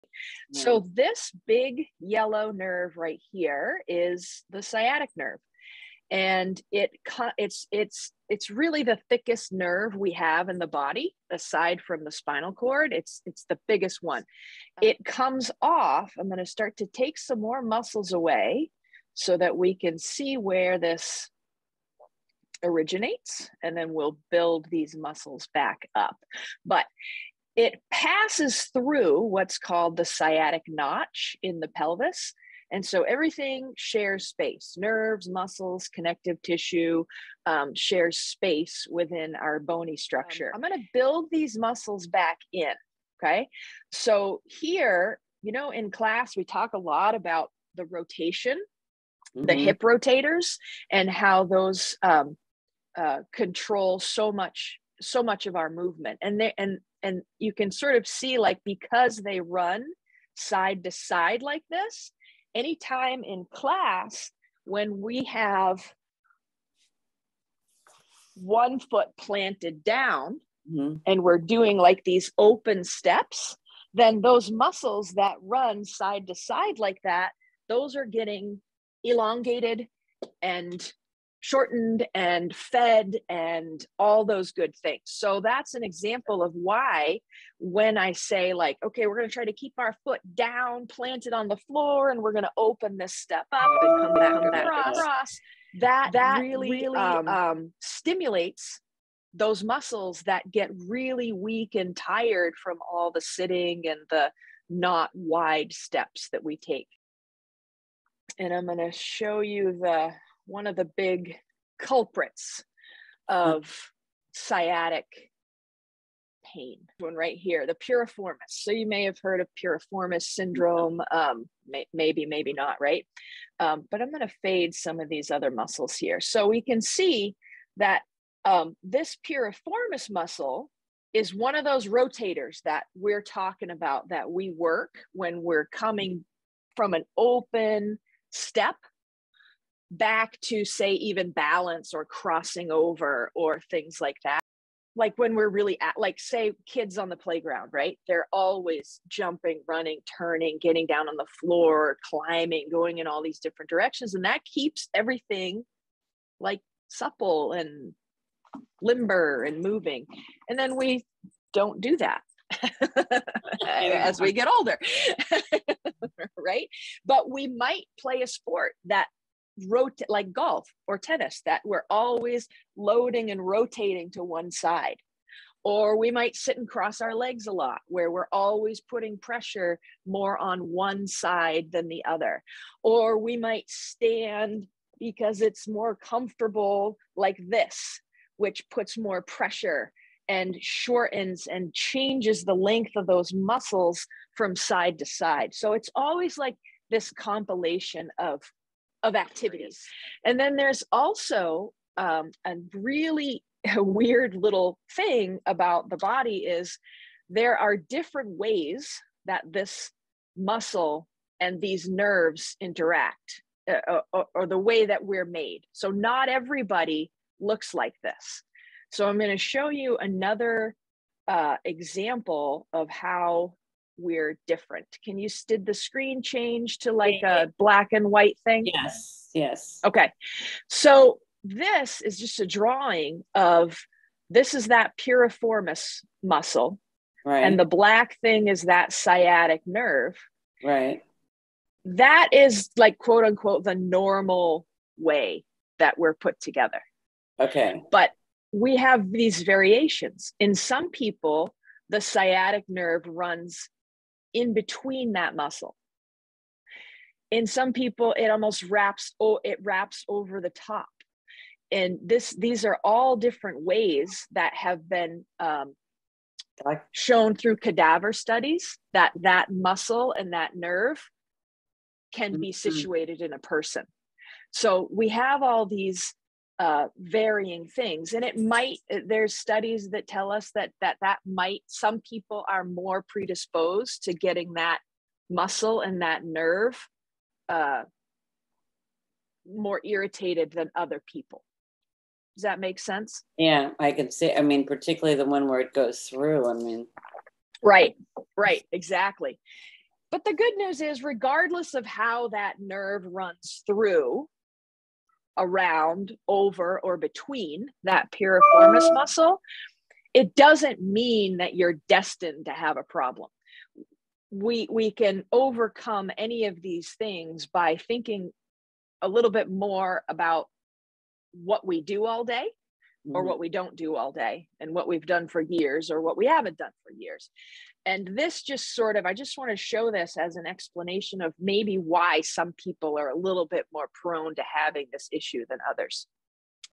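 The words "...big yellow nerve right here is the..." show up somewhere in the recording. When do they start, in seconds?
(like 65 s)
1 s.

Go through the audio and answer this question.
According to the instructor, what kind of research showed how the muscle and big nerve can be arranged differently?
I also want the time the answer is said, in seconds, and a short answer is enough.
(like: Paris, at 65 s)
cadaver studies, at 267 s.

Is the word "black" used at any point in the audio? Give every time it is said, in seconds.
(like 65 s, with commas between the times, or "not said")
227 s, 237 s.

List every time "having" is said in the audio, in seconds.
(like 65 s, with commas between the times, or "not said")
334 s.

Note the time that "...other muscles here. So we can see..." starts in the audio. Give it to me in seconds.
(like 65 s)
125 s.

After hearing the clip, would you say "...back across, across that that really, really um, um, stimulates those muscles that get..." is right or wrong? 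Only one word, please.
right.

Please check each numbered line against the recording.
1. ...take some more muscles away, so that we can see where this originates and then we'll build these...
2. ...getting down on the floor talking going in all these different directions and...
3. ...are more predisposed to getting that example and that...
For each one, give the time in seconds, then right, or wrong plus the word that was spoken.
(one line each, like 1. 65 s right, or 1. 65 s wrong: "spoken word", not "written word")
1. 16 s right
2. 150 s wrong: "climbing", not "talking"
3. 282 s wrong: "muscle", not "example".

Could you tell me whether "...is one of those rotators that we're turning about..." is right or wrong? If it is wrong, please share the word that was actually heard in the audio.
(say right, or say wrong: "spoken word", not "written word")
wrong: "talking", not "turning".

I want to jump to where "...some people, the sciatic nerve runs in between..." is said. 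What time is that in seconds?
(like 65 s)
250 s.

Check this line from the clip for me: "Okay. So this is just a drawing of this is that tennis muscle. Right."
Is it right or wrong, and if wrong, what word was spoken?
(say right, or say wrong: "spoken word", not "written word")
wrong: "piriformis", not "tennis".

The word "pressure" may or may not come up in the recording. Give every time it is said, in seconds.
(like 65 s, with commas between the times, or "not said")
179 s, 189 s.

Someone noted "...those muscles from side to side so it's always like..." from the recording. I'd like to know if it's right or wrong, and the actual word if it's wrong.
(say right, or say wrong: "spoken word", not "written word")
right.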